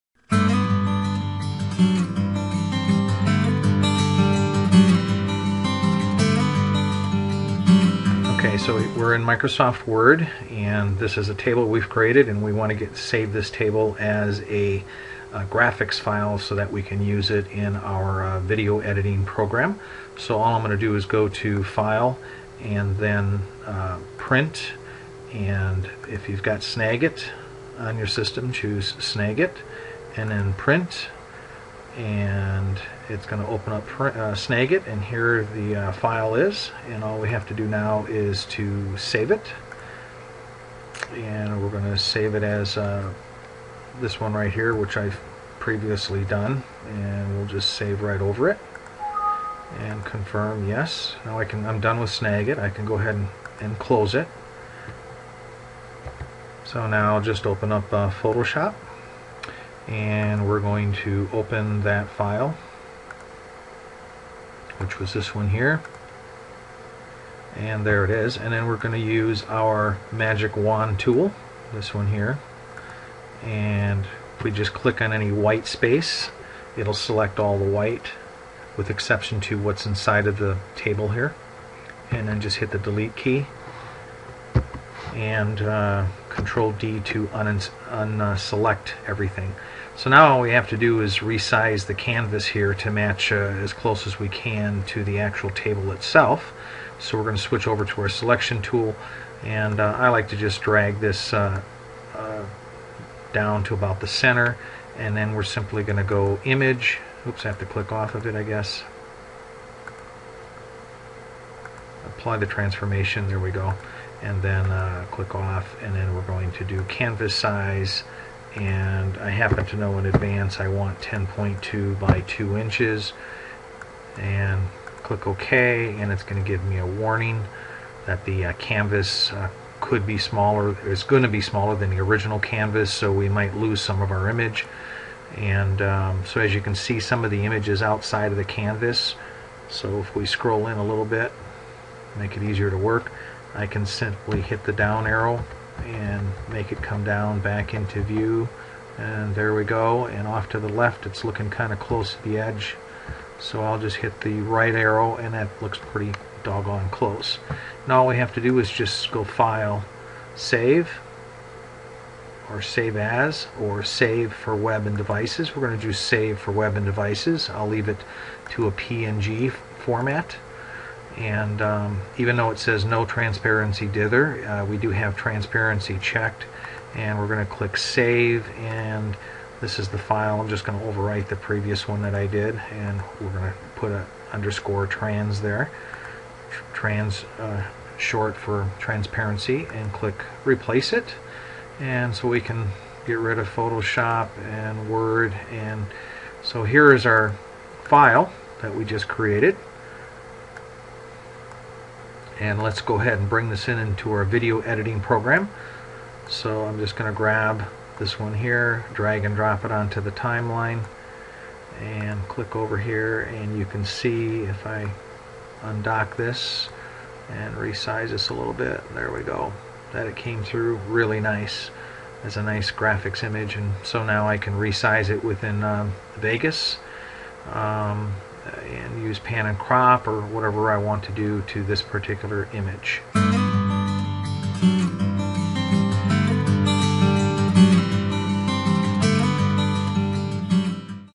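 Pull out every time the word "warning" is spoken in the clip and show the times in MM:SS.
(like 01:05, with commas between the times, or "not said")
02:06.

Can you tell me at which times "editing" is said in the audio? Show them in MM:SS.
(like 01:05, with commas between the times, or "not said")
00:18, 03:24.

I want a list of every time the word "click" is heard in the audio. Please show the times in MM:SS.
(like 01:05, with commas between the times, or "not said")
01:14, 01:47, 01:55, 02:05, 02:57, 03:09, 03:32.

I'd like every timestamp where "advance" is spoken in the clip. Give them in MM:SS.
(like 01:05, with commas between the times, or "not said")
02:00.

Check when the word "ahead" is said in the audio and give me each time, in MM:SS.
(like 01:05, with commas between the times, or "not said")
00:52, 03:22.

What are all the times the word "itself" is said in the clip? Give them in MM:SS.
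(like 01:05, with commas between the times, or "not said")
01:35.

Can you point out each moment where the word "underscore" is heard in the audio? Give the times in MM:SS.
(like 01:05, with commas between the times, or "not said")
03:04.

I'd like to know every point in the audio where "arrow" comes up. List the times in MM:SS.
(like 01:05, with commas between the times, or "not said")
02:25, 02:34.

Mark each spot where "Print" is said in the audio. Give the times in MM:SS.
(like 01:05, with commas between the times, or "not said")
00:24, 00:30.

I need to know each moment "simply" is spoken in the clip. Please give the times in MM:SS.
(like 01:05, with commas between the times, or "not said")
01:45, 02:23.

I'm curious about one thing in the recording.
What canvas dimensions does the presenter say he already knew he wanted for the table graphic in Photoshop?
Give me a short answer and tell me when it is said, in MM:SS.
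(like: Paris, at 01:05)
10.2 by 2 inches, at 02:01.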